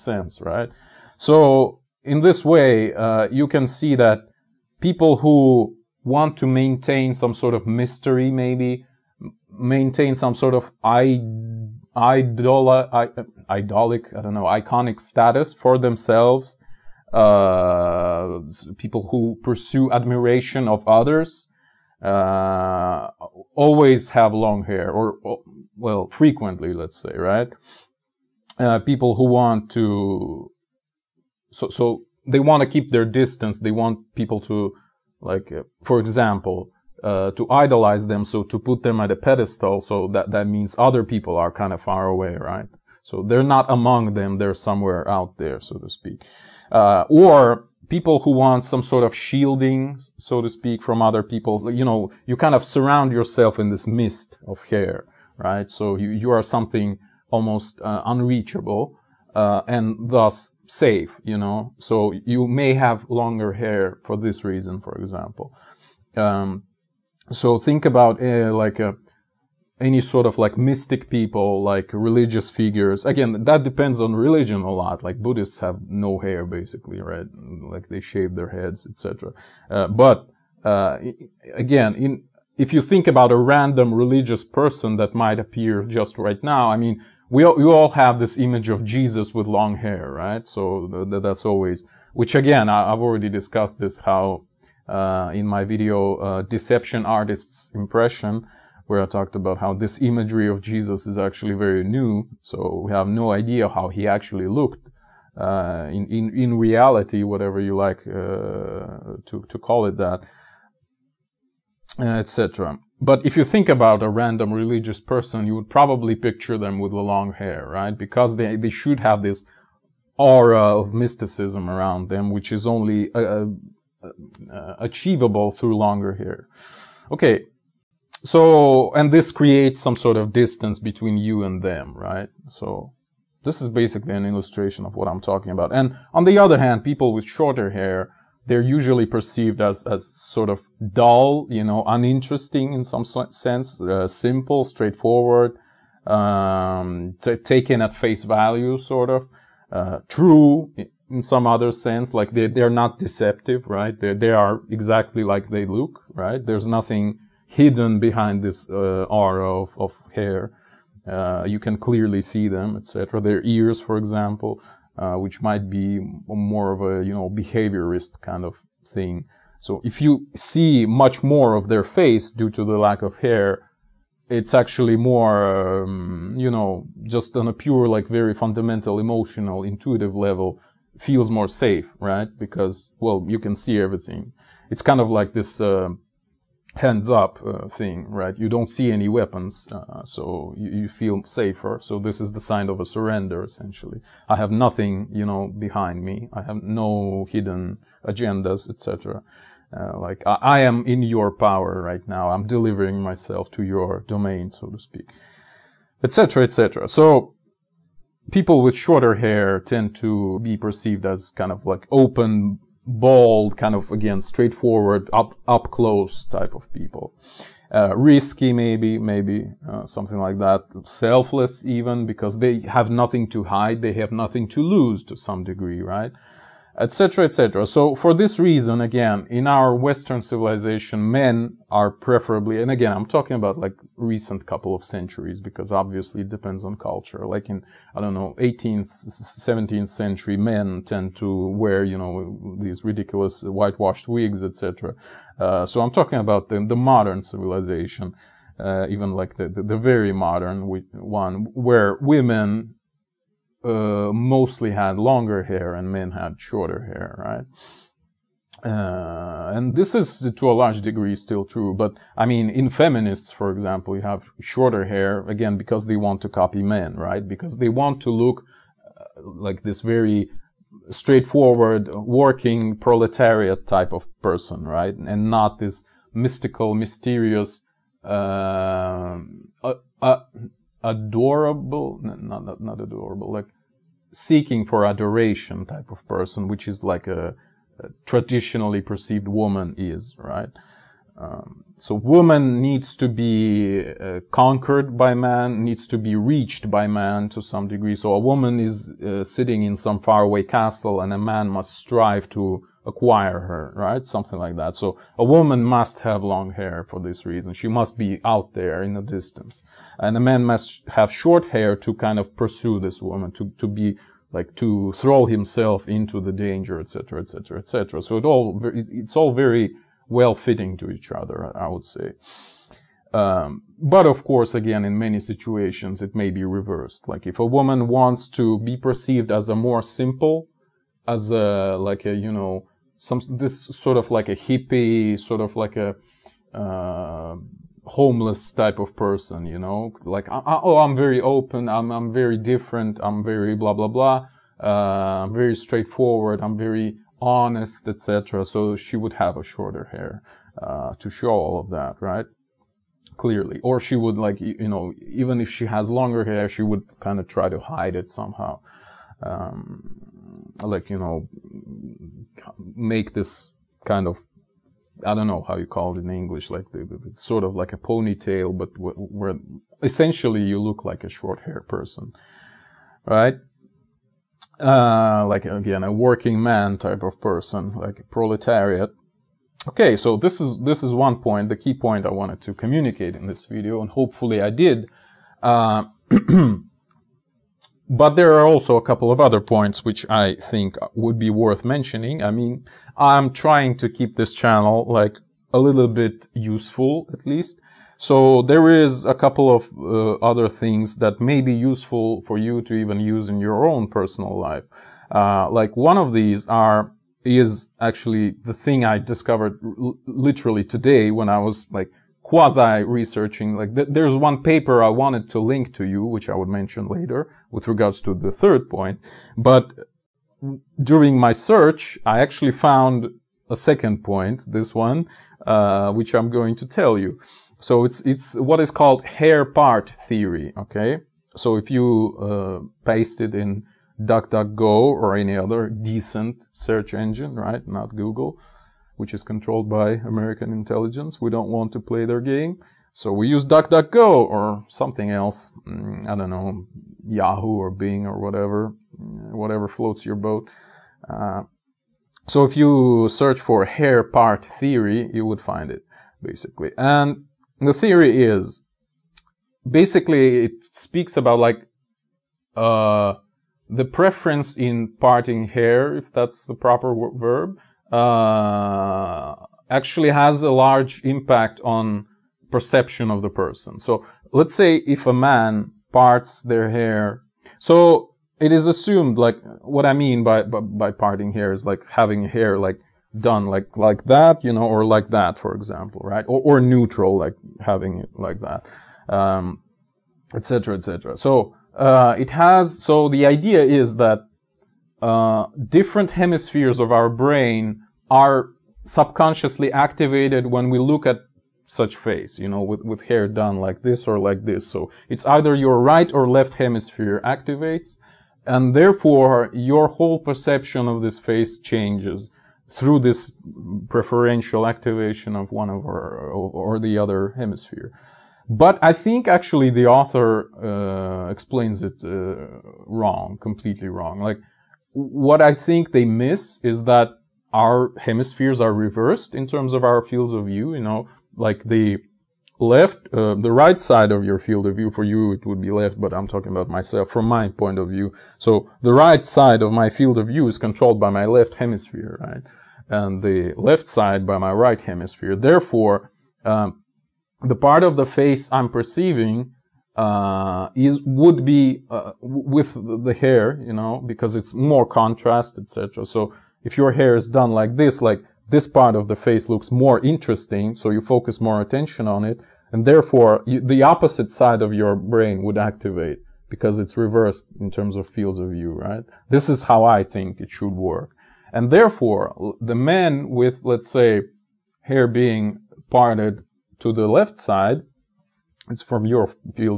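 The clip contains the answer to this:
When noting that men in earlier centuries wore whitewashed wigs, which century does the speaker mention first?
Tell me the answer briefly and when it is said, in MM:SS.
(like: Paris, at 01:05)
18th century, at 03:58.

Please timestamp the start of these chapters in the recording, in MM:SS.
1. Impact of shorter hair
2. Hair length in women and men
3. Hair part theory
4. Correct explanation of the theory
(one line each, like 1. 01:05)
1. 02:14
2. 03:47
3. 07:07
4. 08:37.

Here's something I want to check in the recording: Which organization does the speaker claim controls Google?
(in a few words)
American intelligence.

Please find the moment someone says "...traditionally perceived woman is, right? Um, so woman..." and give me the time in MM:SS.
04:48.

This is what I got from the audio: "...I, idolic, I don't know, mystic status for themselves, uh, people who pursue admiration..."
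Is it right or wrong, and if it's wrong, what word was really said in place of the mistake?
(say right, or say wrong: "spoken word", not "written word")
wrong: "iconic", not "mystic".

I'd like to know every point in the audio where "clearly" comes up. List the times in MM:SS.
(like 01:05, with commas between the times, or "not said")
02:41, 05:53.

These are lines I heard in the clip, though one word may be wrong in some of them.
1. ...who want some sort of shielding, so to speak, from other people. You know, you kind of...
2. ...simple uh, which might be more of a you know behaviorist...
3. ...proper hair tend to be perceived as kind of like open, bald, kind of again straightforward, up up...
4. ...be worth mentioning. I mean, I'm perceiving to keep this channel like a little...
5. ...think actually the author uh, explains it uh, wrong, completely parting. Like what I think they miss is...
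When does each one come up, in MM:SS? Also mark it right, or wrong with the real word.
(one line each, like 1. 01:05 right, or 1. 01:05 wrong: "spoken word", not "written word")
1. 00:48 right
2. 02:43 wrong: "example", not "simple"
3. 03:28 wrong: "shorter", not "proper"
4. 06:31 wrong: "trying", not "perceiving"
5. 08:38 wrong: "wrong", not "parting".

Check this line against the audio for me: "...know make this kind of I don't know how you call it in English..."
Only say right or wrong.
right.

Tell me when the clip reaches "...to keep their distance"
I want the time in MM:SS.
00:32.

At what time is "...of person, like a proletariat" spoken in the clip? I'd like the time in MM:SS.
06:17.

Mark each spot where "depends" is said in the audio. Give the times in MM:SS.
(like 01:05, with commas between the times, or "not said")
01:13, 03:56.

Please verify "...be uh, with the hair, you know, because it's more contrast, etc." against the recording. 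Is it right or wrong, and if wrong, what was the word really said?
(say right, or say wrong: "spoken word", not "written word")
right.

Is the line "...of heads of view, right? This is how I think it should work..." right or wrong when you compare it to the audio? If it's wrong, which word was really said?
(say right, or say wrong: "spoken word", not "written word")
wrong: "fields", not "heads".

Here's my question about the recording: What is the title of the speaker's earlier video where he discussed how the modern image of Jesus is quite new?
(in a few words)
Deception Artist's Impression.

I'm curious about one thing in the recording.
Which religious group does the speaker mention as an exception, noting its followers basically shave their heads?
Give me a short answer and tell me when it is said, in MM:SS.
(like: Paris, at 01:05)
Buddhists, at 01:15.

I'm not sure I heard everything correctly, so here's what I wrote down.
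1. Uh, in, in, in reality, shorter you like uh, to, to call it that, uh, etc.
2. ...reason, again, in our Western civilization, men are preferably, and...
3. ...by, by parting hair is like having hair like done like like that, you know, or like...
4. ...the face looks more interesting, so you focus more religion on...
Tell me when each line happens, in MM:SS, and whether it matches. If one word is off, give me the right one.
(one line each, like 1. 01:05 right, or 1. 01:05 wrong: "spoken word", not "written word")
1. 01:45 wrong: "whatever", not "shorter"
2. 03:48 right
3. 08:00 right
4. 09:19 wrong: "attention", not "religion".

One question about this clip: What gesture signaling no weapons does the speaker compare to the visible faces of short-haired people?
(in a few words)
Hands up.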